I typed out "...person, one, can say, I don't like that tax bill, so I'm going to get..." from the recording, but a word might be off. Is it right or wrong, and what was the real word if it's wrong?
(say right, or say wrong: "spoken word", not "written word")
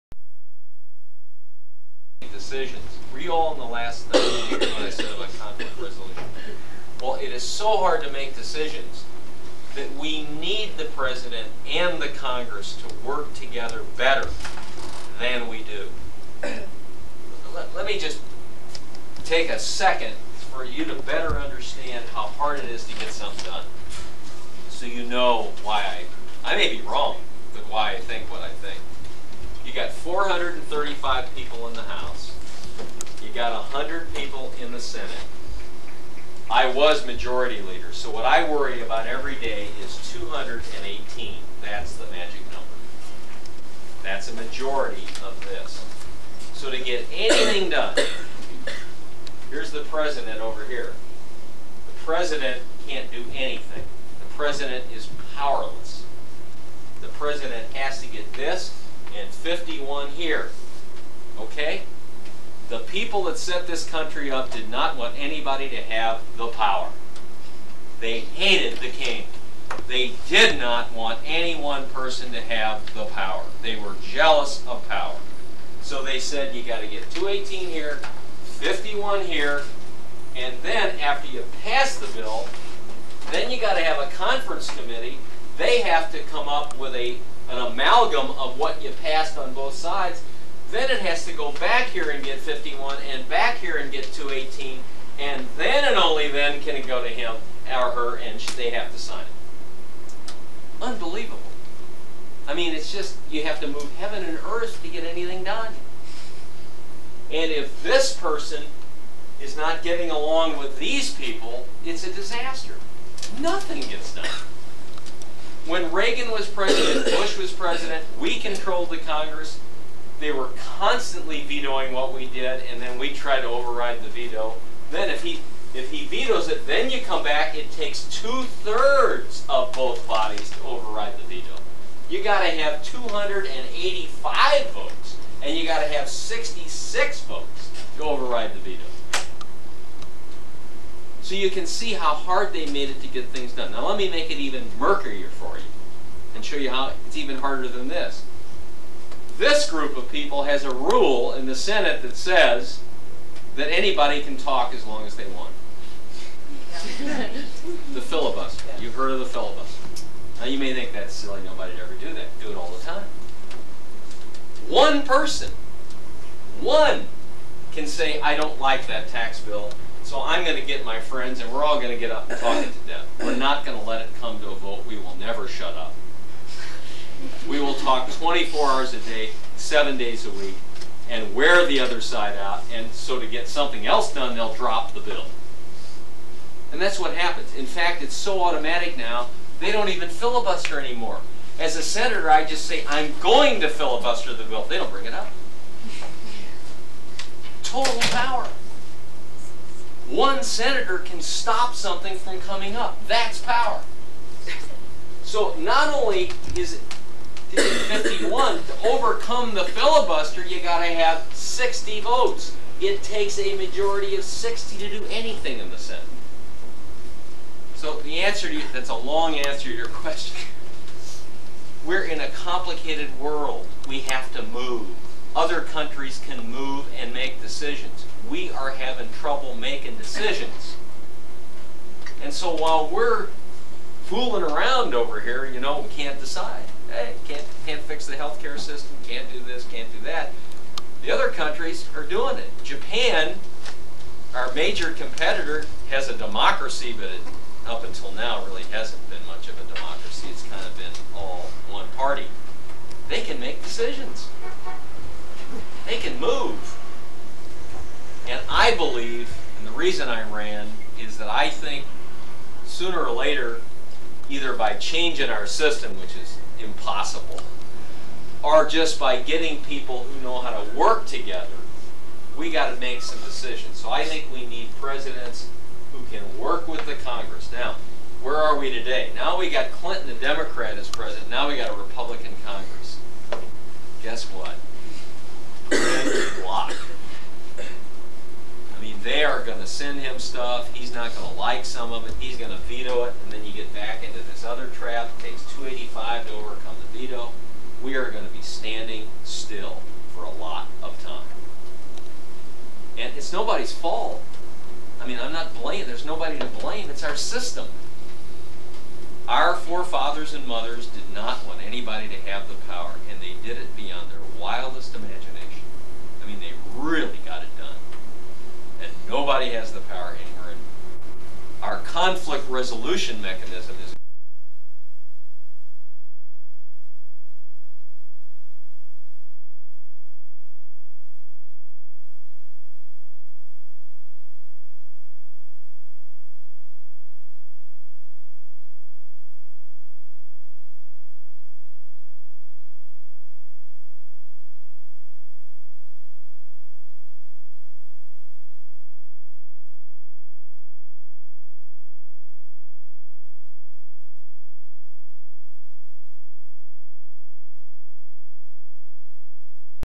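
right.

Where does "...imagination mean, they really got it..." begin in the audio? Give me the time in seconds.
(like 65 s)
314 s.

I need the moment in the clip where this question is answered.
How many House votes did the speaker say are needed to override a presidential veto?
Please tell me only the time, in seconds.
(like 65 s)
132 s.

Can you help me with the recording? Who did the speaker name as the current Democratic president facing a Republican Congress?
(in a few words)
Clinton.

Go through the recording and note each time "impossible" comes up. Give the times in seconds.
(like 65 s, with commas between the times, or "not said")
266 s.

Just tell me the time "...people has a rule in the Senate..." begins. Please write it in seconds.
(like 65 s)
150 s.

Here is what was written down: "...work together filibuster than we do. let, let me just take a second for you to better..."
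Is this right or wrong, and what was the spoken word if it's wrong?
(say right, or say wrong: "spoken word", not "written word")
wrong: "better", not "filibuster".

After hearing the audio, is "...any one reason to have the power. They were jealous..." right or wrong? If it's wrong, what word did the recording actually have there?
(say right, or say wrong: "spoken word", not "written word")
wrong: "person", not "reason".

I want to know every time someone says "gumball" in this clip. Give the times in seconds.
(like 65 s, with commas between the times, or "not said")
not said.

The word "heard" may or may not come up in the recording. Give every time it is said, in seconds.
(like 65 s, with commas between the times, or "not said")
158 s.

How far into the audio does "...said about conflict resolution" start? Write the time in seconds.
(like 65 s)
4 s.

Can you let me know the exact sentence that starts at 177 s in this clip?
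We will talk 24 hours a day, seven days a week, and wear the other side out.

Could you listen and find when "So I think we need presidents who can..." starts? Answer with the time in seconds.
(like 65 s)
273 s.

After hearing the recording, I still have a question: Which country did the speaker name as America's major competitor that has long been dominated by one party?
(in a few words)
Japan.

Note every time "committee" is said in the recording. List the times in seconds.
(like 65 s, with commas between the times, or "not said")
84 s.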